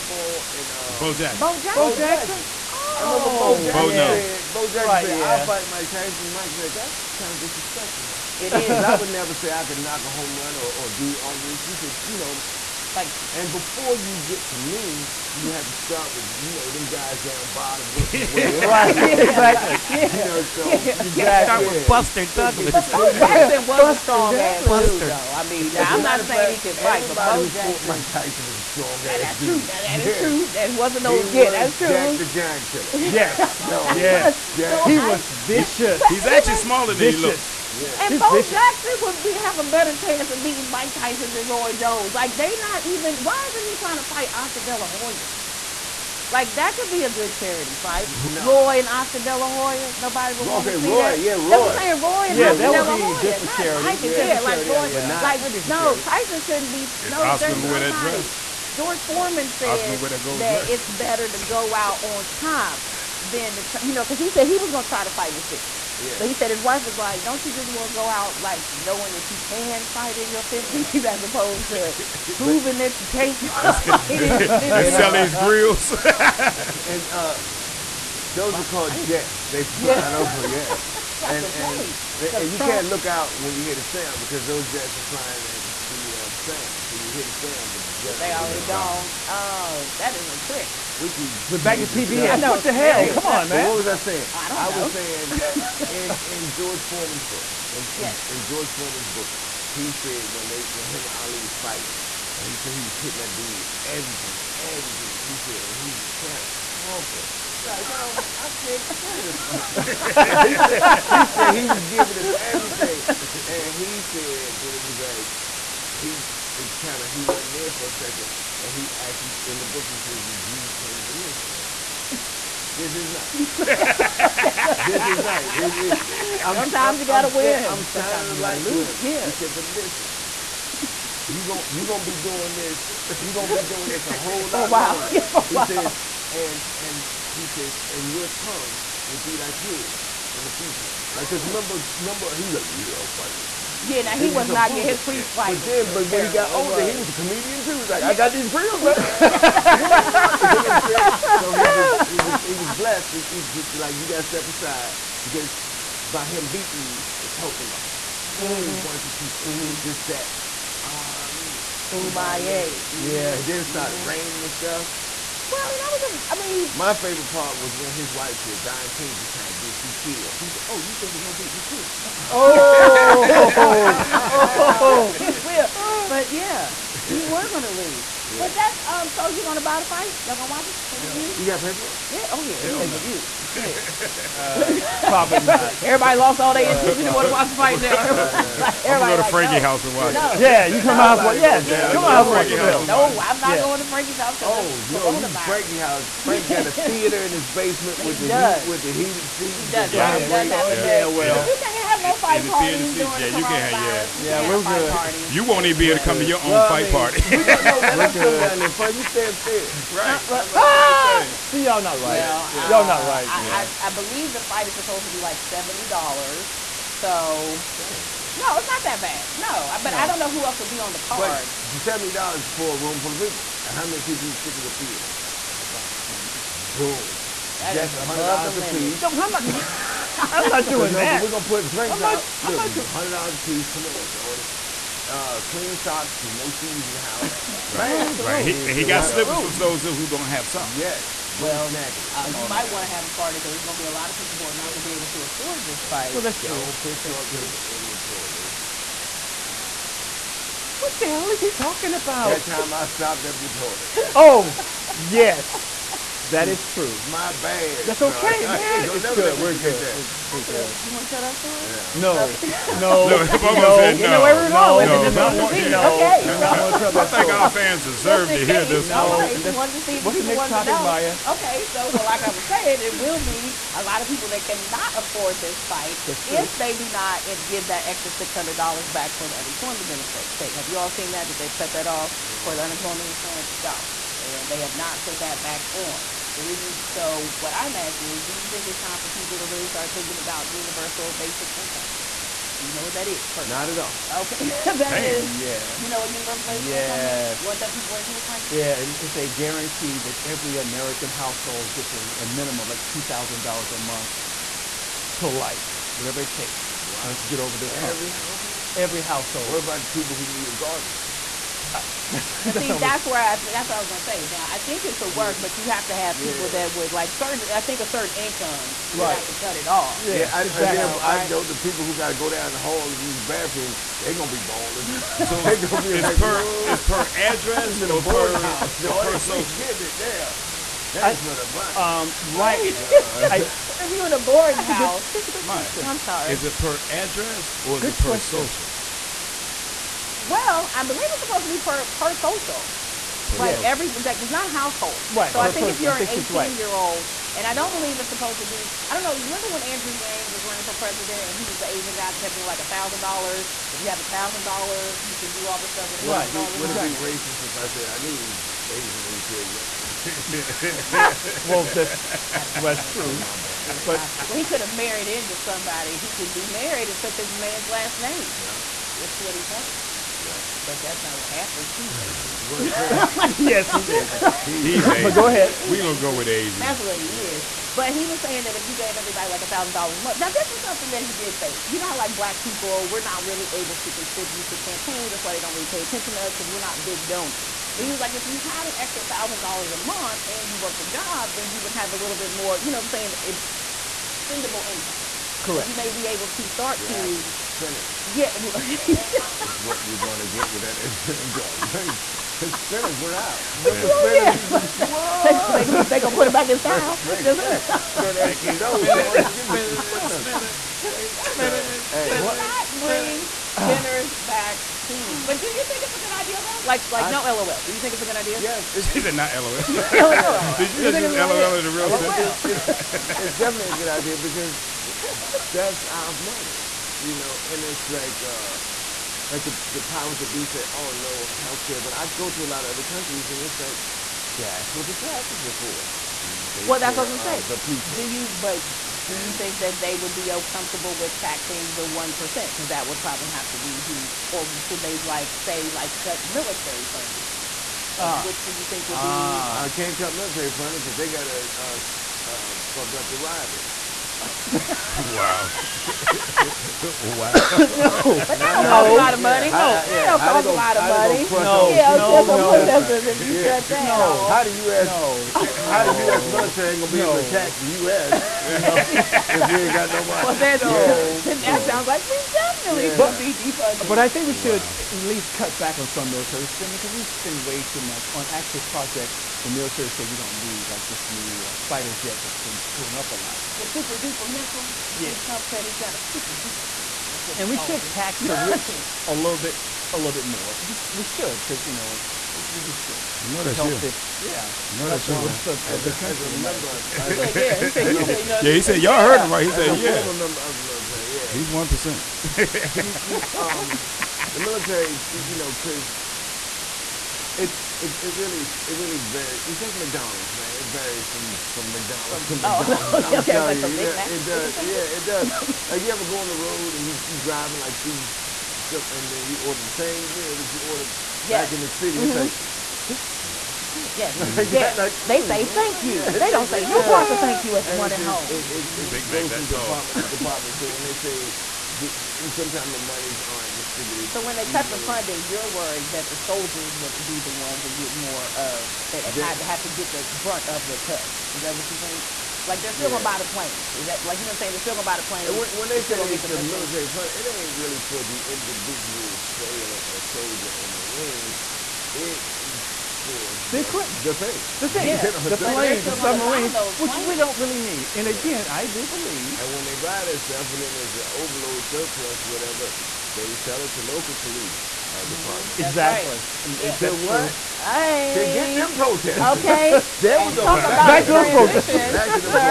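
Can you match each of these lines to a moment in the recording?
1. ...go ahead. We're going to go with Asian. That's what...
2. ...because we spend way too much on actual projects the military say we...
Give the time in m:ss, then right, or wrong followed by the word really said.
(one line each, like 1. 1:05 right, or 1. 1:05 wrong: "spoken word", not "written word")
1. 6:15 right
2. 7:56 right.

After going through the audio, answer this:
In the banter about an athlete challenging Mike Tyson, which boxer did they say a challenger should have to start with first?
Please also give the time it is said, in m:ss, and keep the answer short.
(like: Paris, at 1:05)
Buster Douglas, at 0:21.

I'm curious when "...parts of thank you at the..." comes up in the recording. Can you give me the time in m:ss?
8:46.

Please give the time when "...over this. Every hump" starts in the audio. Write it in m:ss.
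5:07.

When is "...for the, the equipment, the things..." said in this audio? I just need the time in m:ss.
9:13.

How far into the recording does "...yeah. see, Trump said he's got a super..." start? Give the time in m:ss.
8:04.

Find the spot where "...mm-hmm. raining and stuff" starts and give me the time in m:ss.
2:43.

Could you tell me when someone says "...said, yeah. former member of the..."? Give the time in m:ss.
8:19.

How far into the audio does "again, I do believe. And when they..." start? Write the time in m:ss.
9:18.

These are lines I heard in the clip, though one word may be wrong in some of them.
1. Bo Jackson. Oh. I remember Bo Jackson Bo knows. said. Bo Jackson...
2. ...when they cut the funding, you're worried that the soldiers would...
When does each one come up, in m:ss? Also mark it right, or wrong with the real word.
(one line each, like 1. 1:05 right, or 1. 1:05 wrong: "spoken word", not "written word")
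1. 0:01 right
2. 8:54 right.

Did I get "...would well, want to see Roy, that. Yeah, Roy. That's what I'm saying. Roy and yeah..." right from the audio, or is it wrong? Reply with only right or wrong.
right.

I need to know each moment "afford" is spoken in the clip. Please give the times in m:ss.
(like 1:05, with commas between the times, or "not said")
4:05, 4:34.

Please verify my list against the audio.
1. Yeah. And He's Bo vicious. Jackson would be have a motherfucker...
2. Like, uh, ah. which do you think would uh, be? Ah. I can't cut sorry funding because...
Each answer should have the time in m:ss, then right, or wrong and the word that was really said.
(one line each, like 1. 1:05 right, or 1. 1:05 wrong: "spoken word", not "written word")
1. 0:37 wrong: "better", not "motherfucker"
2. 7:27 wrong: "military", not "sorry".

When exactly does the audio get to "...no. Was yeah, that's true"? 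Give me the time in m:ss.
0:31.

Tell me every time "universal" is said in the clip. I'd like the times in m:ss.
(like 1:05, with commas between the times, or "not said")
4:50, 4:56.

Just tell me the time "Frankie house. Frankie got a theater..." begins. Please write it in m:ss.
3:15.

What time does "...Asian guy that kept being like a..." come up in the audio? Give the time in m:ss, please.
5:51.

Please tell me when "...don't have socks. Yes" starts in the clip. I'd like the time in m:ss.
4:00.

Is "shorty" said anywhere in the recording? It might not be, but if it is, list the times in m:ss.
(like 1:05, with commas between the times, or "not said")
3:54.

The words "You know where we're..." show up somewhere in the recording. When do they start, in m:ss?
4:23.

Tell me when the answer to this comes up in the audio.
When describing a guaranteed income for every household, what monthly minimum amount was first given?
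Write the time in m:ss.
5:02.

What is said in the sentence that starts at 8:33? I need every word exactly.
okay, like you, it, it does.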